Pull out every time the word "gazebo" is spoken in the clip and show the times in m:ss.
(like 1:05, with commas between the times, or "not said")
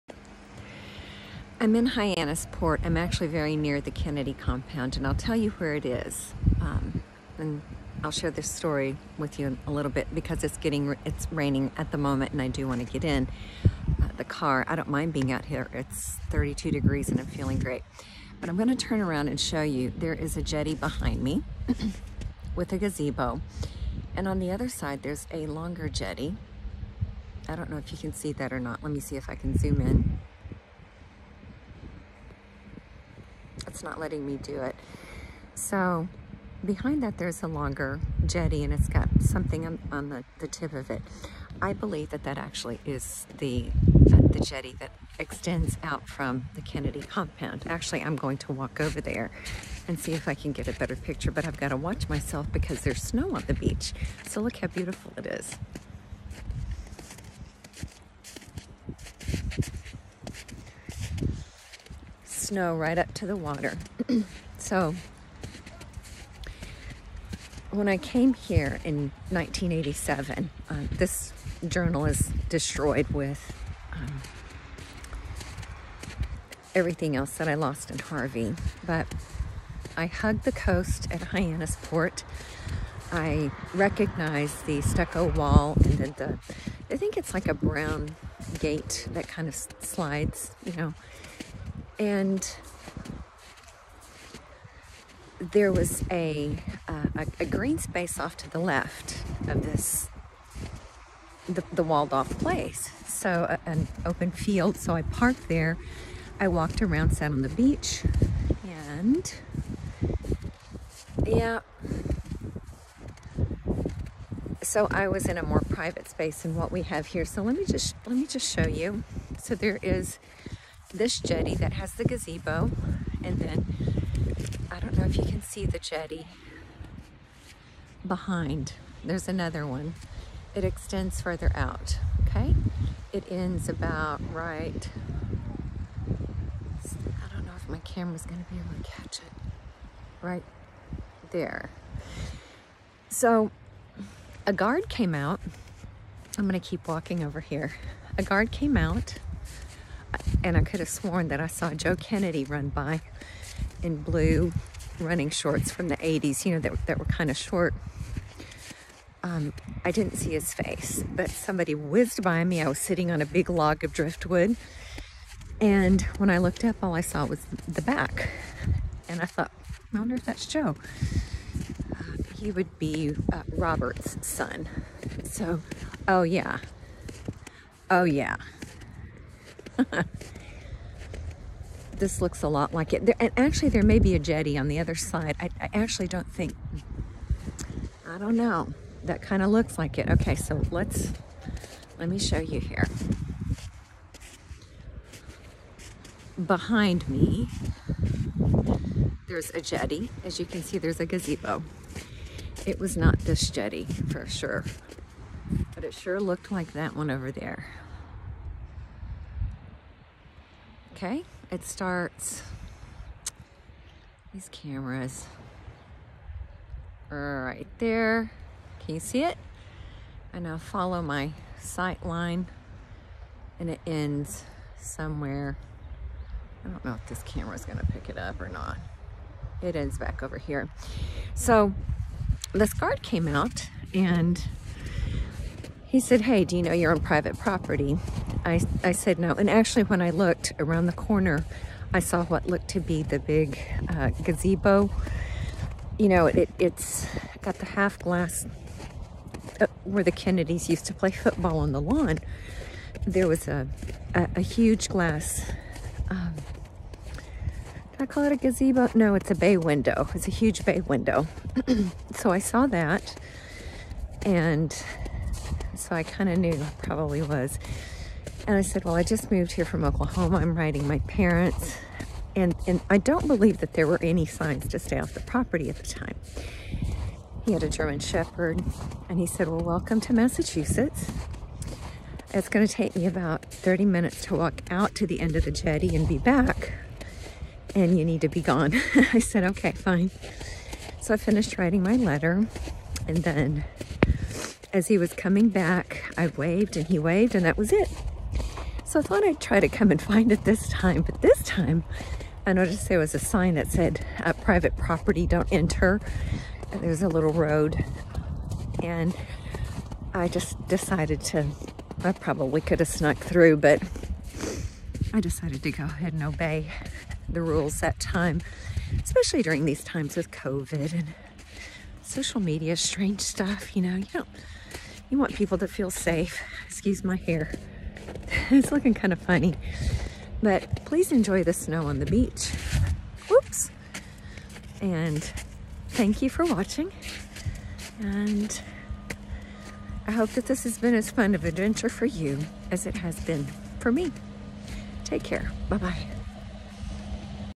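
0:22, 2:02, 3:21, 4:04, 4:18.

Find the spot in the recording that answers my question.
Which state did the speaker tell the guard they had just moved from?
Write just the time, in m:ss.
4:29.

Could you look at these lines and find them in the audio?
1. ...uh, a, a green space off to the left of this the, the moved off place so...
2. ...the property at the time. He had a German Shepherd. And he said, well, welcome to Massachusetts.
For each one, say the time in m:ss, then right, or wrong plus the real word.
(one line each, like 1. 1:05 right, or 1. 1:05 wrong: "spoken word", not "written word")
1. 1:36 wrong: "walled", not "moved"
2. 4:35 right.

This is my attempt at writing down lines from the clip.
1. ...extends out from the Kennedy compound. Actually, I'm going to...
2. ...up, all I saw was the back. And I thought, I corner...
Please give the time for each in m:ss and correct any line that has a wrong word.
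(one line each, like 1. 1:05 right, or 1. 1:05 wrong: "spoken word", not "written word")
1. 0:45 right
2. 2:46 wrong: "wonder", not "corner".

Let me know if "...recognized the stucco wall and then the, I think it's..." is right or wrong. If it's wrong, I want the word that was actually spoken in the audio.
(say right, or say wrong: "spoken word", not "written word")
right.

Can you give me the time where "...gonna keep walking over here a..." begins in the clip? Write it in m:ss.
2:26.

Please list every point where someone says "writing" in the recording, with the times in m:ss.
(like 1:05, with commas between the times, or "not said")
4:30, 4:51.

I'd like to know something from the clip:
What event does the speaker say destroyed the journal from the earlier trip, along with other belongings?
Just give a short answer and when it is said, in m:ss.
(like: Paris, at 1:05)
Harvey, at 1:17.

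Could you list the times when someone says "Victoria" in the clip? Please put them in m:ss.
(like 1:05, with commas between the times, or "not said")
not said.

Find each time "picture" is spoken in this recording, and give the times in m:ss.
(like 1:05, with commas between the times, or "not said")
0:50.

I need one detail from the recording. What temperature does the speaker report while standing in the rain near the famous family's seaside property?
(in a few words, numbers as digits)
32 degrees.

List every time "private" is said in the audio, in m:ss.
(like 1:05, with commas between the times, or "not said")
1:55, 3:57, 5:04.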